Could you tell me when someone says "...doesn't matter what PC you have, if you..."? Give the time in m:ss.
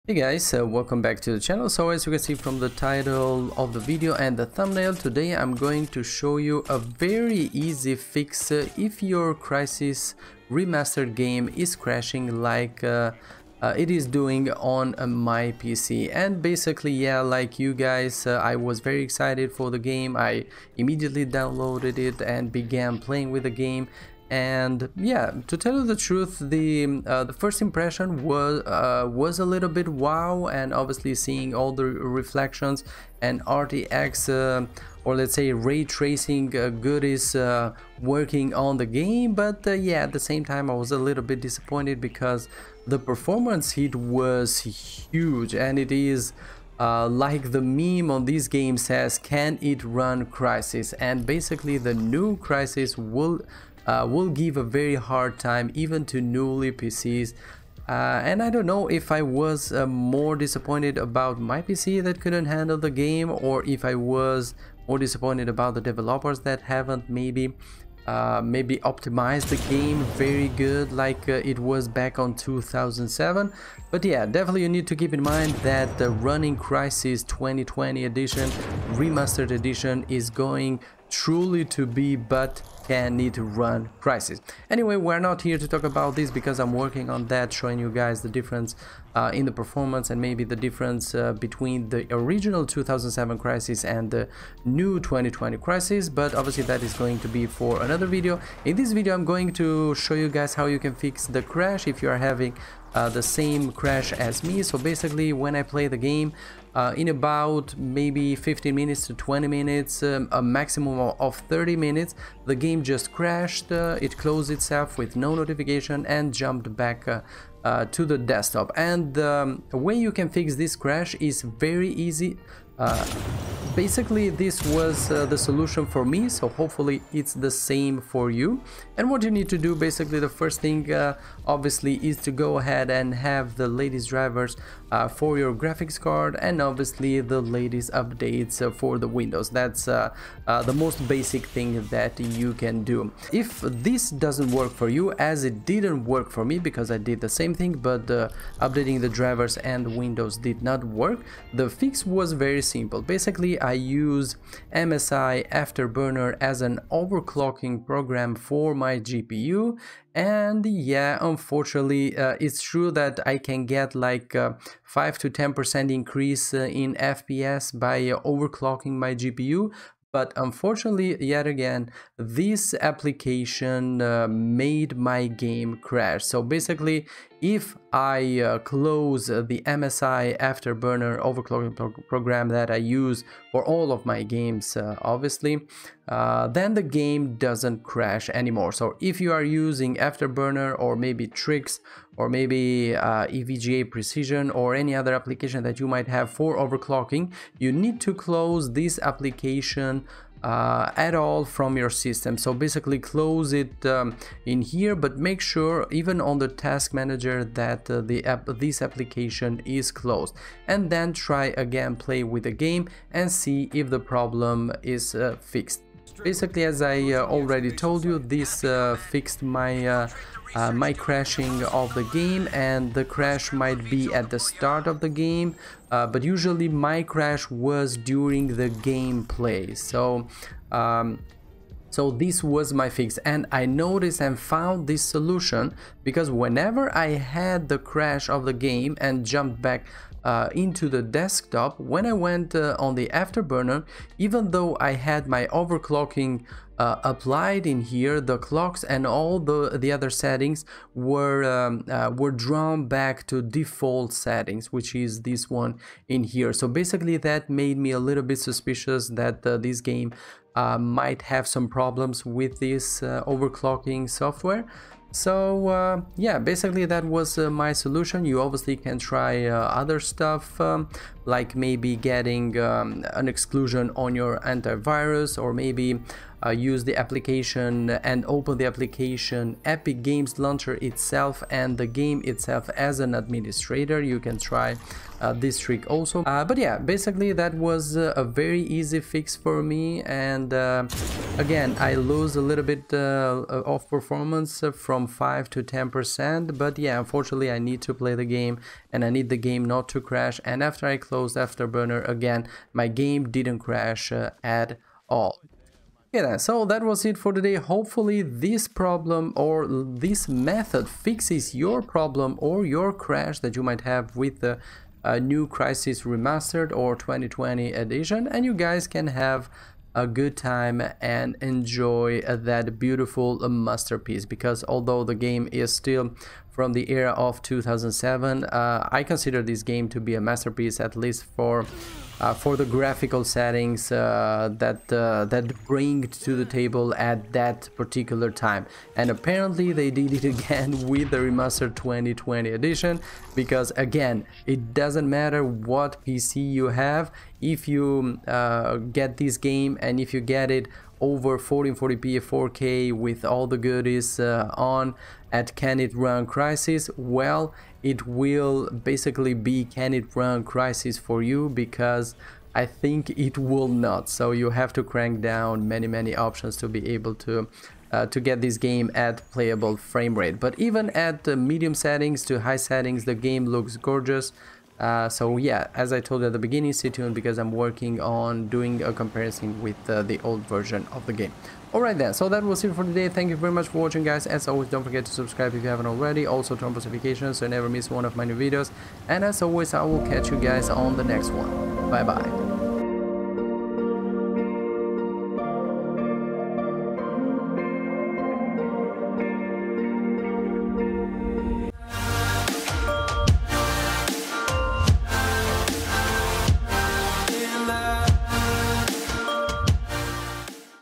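5:44.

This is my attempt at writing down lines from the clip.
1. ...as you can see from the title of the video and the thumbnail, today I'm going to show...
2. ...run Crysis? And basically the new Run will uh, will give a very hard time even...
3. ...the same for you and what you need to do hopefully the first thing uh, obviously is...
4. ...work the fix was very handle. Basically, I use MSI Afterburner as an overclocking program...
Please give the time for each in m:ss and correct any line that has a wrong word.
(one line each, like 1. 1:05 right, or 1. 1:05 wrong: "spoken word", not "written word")
1. 0:01 right
2. 0:49 wrong: "Crysis", not "Run"
3. 2:07 wrong: "basically", not "hopefully"
4. 2:30 wrong: "simple", not "handle".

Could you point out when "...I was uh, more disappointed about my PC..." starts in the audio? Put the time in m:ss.
0:59.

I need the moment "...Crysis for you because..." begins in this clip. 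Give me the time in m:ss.
6:00.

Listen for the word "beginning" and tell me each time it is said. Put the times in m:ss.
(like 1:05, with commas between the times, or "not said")
6:16.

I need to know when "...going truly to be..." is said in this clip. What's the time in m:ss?
1:20.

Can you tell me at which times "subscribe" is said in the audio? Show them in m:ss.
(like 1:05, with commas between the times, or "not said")
6:25.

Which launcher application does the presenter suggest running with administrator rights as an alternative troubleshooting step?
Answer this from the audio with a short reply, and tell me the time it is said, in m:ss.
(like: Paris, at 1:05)
Epic Games Launcher, at 4:39.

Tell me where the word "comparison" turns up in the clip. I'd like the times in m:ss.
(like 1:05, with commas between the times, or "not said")
6:18.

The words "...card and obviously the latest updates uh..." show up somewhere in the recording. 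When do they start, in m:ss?
2:15.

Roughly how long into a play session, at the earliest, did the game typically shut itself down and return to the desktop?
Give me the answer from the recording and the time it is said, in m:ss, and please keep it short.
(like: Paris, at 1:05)
15 minutes, at 1:48.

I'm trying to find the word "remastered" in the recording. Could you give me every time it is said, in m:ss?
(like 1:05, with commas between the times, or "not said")
0:10, 1:18, 5:16, 5:41.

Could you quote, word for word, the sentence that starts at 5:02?
My game didn't crash uh, at all.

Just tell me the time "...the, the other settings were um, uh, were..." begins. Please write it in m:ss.
4:09.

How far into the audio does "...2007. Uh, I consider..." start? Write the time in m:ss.
5:27.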